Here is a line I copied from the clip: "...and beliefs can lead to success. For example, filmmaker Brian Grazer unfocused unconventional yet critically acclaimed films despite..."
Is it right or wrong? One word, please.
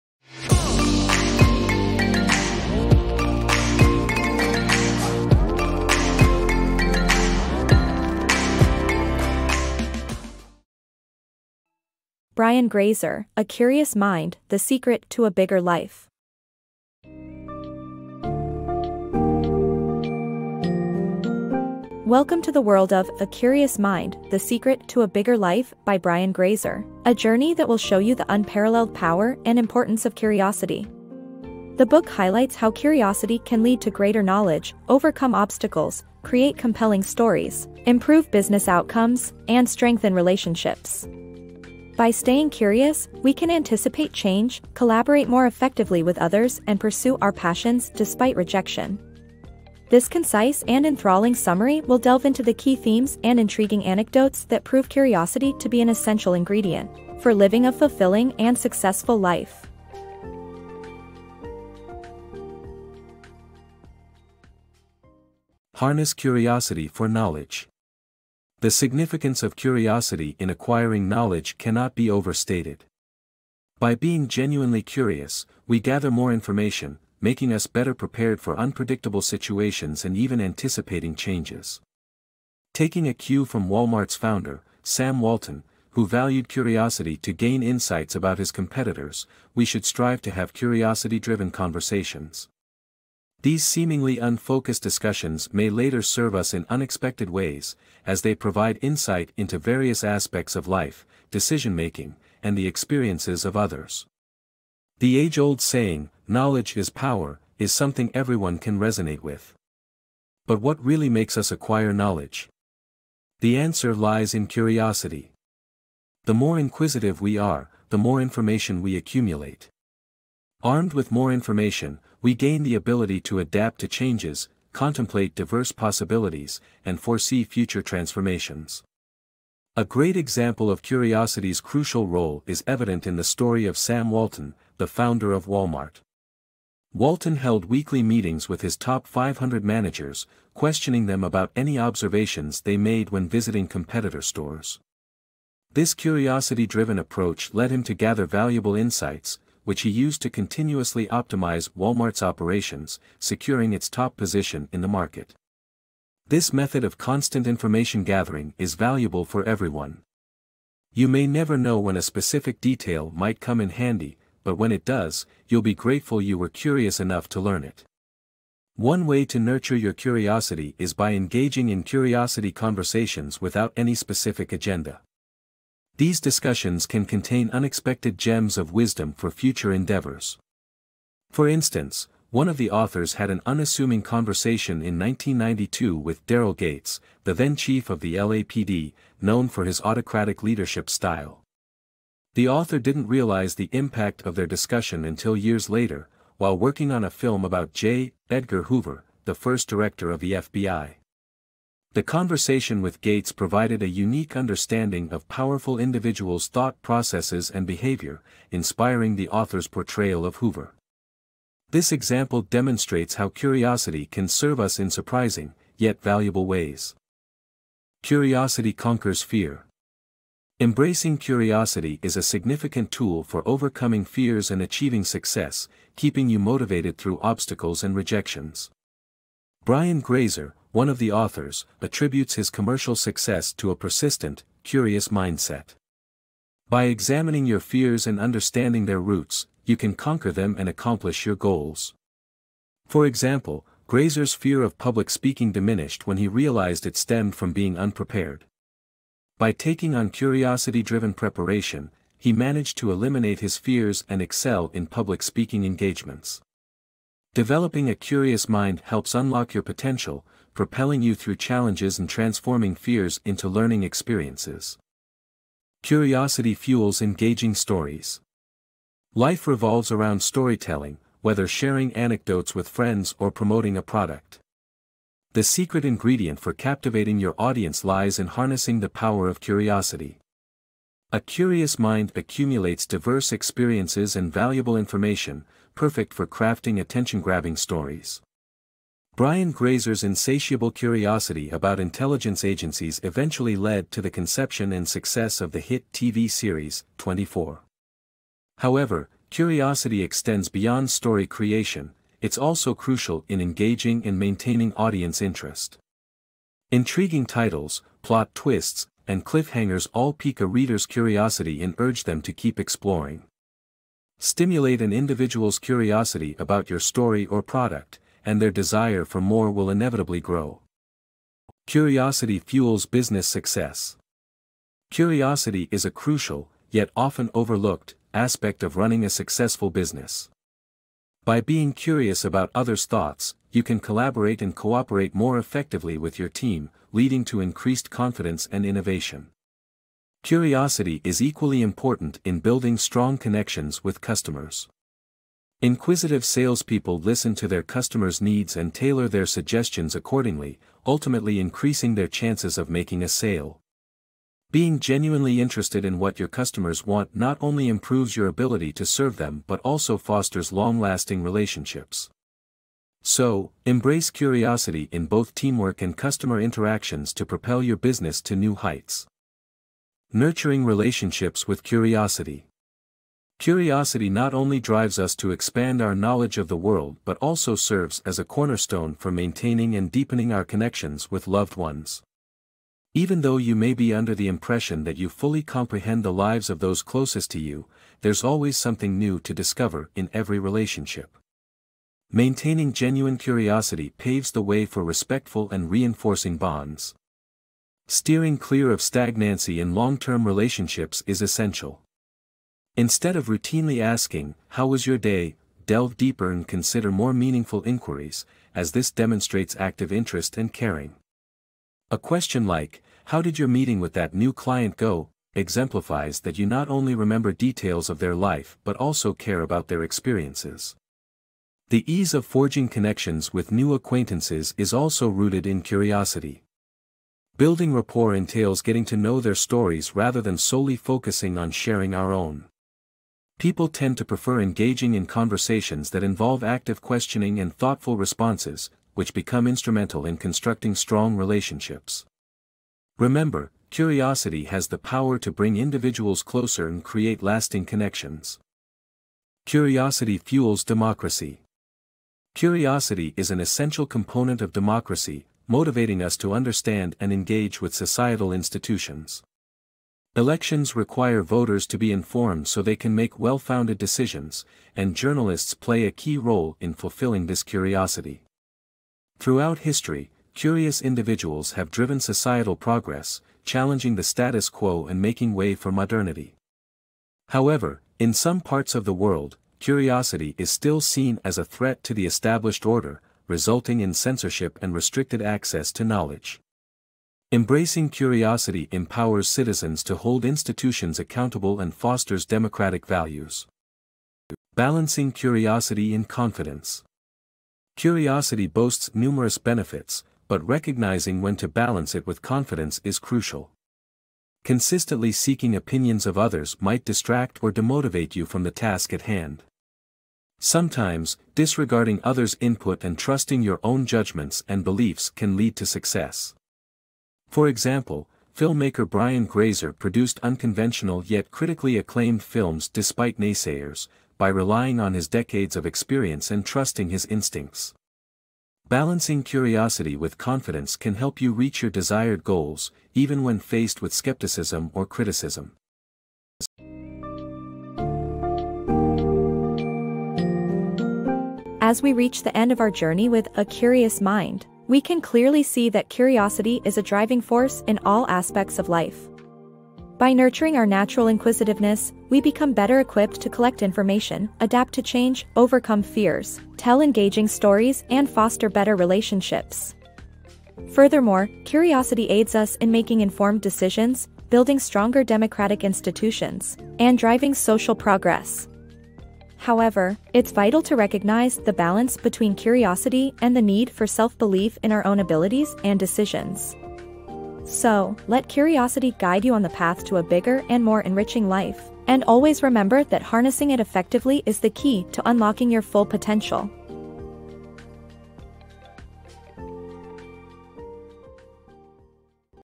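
wrong.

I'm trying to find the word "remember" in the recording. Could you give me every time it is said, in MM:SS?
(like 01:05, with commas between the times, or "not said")
06:56, 07:22, 09:42.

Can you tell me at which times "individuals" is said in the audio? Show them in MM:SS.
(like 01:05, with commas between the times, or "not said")
03:25, 05:14, 07:25, 07:50.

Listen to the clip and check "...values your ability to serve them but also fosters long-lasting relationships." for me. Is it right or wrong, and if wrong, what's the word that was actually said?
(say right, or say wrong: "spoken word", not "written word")
wrong: "improves", not "values".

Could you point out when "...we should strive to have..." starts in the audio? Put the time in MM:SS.
01:29.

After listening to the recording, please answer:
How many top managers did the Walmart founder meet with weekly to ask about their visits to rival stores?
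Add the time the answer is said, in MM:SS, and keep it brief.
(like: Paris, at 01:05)
500, at 02:19.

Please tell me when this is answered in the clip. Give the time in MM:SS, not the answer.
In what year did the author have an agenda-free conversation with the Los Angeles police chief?
03:04.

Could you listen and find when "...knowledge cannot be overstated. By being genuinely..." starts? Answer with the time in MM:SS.
01:11.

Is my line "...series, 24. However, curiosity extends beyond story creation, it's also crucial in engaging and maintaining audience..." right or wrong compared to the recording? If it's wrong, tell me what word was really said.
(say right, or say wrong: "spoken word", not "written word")
right.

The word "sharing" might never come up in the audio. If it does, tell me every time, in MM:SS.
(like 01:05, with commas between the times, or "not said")
04:31, 07:11.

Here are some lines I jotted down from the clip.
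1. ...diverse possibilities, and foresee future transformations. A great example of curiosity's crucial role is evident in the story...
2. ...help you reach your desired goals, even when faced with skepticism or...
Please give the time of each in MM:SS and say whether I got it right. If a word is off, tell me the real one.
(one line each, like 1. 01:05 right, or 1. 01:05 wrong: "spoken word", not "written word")
1. 02:05 right
2. 08:50 right.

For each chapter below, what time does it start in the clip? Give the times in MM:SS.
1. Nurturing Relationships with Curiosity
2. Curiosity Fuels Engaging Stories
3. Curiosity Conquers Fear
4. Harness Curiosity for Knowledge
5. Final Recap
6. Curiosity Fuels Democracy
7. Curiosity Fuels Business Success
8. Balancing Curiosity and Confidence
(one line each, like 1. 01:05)
1. 06:10
2. 04:26
3. 03:38
4. 01:06
5. 08:57
6. 07:30
7. 05:22
8. 08:15.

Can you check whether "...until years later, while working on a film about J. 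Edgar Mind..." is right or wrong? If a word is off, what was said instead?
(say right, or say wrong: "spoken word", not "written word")
wrong: "Hoover", not "Mind".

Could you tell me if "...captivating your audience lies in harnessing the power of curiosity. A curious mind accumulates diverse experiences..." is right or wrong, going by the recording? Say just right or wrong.
right.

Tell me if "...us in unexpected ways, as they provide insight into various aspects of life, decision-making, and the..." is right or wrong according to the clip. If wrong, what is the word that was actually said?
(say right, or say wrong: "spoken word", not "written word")
right.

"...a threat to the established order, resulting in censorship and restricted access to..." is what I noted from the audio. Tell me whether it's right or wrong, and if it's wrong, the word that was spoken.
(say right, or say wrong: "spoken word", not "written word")
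right.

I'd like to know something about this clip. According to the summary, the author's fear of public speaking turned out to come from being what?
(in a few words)
Unprepared.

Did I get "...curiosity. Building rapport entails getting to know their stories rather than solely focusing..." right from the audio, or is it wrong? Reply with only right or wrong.
right.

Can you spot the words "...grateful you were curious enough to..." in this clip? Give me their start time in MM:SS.
02:45.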